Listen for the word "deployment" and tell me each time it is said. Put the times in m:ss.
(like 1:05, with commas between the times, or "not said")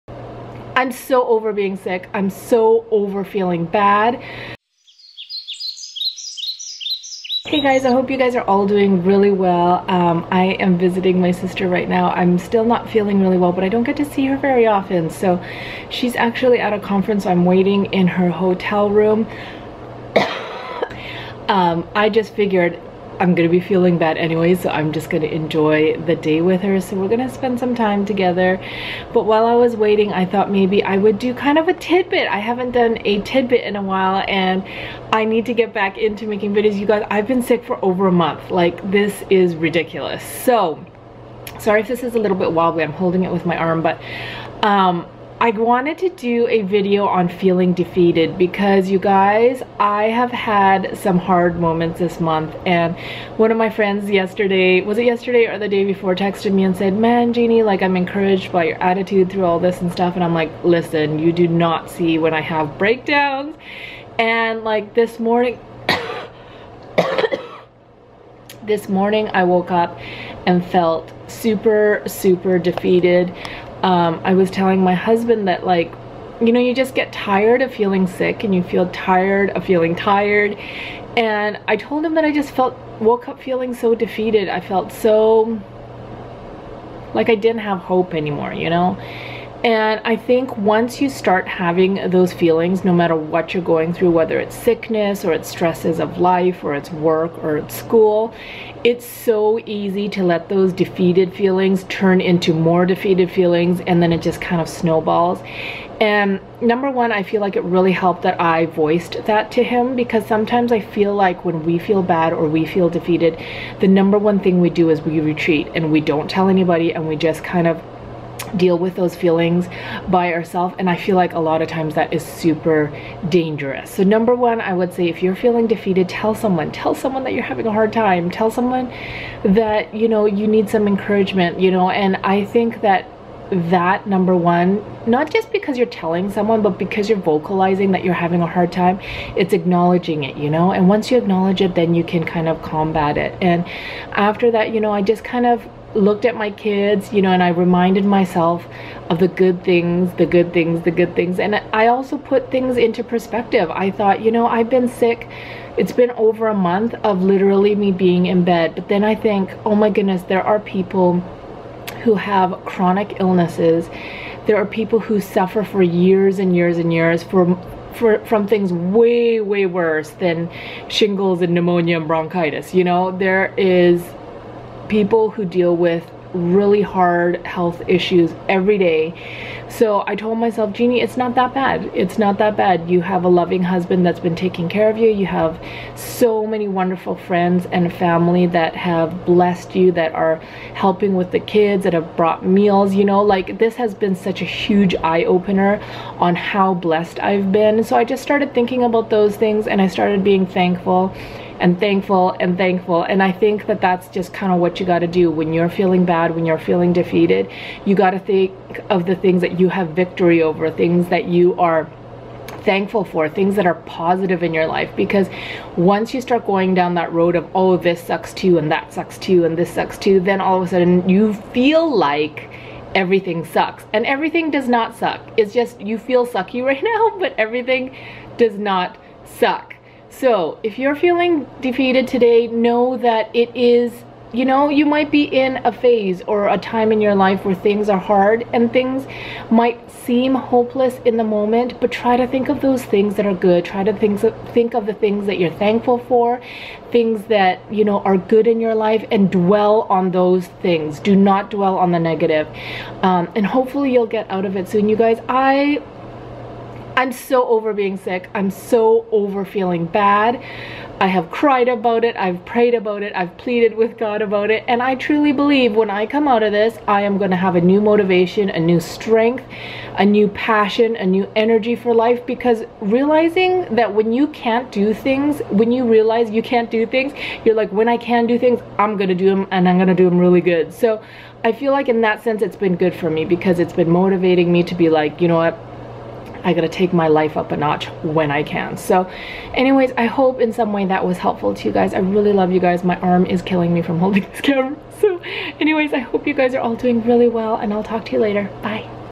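not said.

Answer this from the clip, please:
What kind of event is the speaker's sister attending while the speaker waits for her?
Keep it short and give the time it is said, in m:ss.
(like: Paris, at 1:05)
A conference, at 0:16.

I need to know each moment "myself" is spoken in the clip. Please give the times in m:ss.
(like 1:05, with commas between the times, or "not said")
2:28, 3:00.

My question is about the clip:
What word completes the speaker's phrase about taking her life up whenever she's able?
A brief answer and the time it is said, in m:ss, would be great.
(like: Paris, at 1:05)
A notch, at 4:47.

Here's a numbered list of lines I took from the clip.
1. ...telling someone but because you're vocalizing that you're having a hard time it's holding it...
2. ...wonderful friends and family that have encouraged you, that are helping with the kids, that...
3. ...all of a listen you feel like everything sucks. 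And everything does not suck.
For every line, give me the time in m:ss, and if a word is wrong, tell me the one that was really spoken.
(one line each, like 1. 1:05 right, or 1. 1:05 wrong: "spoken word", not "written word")
1. 2:15 wrong: "acknowledging", not "holding"
2. 3:06 wrong: "blessed", not "encouraged"
3. 3:40 wrong: "sudden", not "listen".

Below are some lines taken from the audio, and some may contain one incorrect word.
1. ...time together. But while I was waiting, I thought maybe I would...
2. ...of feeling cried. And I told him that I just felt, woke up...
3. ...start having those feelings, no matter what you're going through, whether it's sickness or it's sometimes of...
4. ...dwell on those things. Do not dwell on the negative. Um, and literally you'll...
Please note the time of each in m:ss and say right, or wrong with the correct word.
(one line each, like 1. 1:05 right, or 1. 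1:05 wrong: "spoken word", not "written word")
1. 0:27 right
2. 1:19 wrong: "tired", not "cried"
3. 1:31 wrong: "stresses", not "sometimes"
4. 4:09 wrong: "hopefully", not "literally".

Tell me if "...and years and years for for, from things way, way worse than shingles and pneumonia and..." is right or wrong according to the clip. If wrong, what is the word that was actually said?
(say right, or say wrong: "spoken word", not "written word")
right.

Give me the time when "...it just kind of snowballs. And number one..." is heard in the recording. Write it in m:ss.
1:44.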